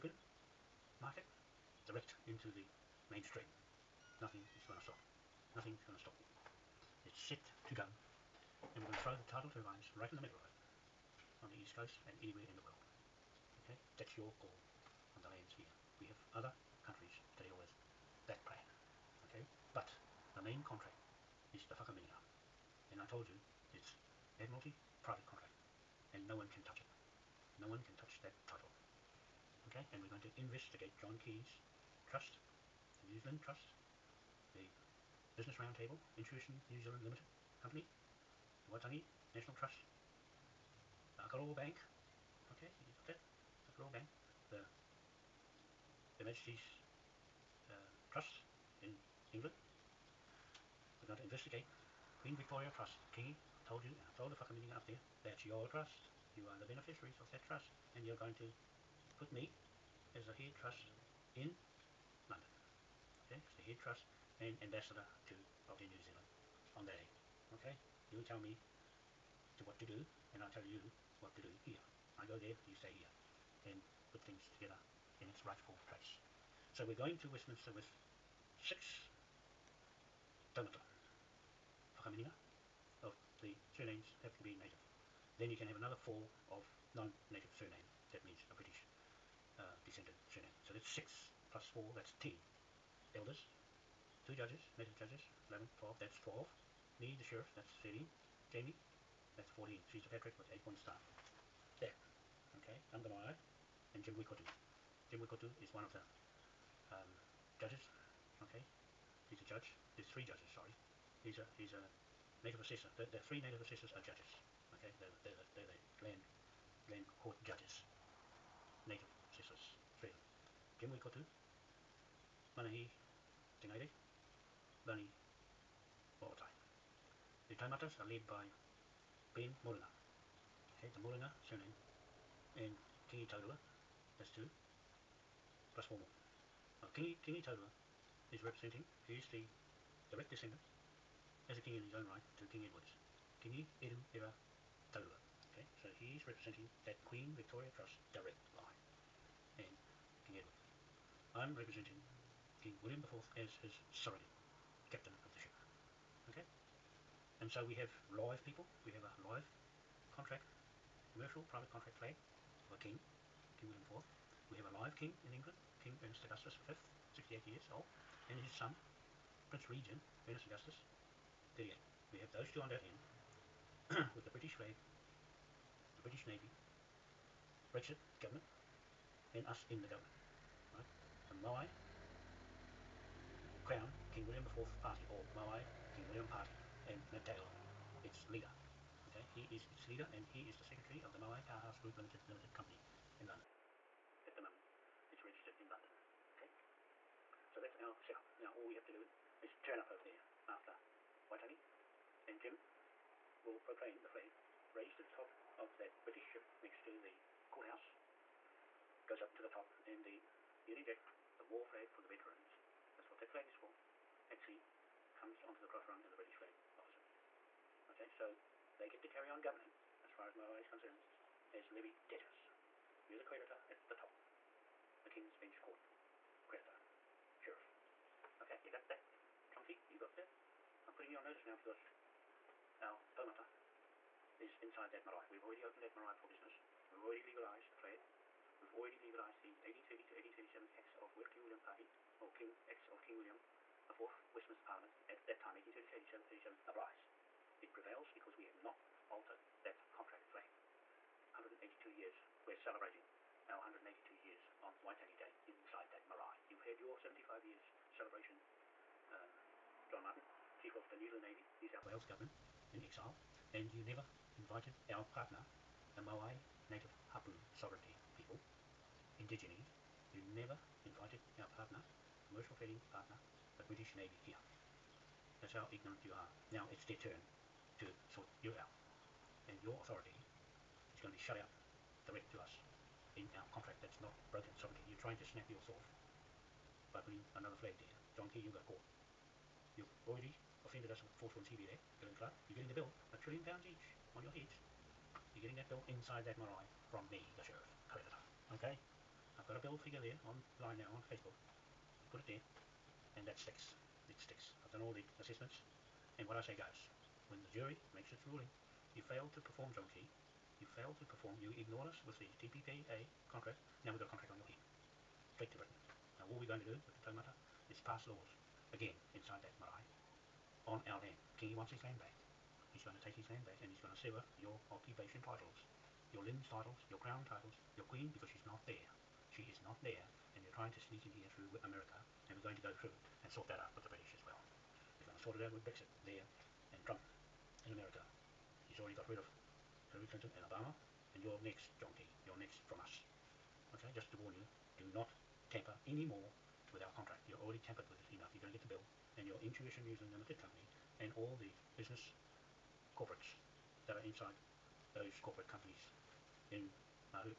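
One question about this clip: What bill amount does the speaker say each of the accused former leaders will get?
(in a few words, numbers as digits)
a trillion pounds each.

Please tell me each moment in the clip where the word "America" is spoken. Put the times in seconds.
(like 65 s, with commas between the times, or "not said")
331 s, 337 s.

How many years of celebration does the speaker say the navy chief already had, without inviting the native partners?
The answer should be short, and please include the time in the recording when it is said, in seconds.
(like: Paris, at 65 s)
75 years, at 256 s.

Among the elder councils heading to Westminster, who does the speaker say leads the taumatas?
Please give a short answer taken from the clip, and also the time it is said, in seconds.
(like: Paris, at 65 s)
Ben Moringa, at 129 s.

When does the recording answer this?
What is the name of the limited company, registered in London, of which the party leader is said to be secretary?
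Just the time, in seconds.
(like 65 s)
191 s.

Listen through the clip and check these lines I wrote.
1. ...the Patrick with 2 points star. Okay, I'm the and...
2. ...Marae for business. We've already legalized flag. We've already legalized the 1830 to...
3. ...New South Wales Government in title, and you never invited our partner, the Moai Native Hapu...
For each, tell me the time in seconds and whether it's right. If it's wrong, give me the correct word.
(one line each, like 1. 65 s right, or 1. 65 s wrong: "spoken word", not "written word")
1. 100 s wrong: "8", not "2"
2. 235 s right
3. 261 s wrong: "exile", not "title".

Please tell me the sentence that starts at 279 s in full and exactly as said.
And your authority is going to be shut out direct to us in our contract that's not broken sovereignty.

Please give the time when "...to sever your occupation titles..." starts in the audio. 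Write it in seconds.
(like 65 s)
323 s.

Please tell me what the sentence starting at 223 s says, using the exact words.
We're the creditor at the top, the King's Bench Court, creditor, sheriff.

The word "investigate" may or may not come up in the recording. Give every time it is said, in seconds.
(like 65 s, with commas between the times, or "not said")
30 s, 51 s.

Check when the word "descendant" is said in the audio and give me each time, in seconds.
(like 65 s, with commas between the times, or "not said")
89 s, 140 s.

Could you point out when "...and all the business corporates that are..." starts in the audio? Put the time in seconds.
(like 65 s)
350 s.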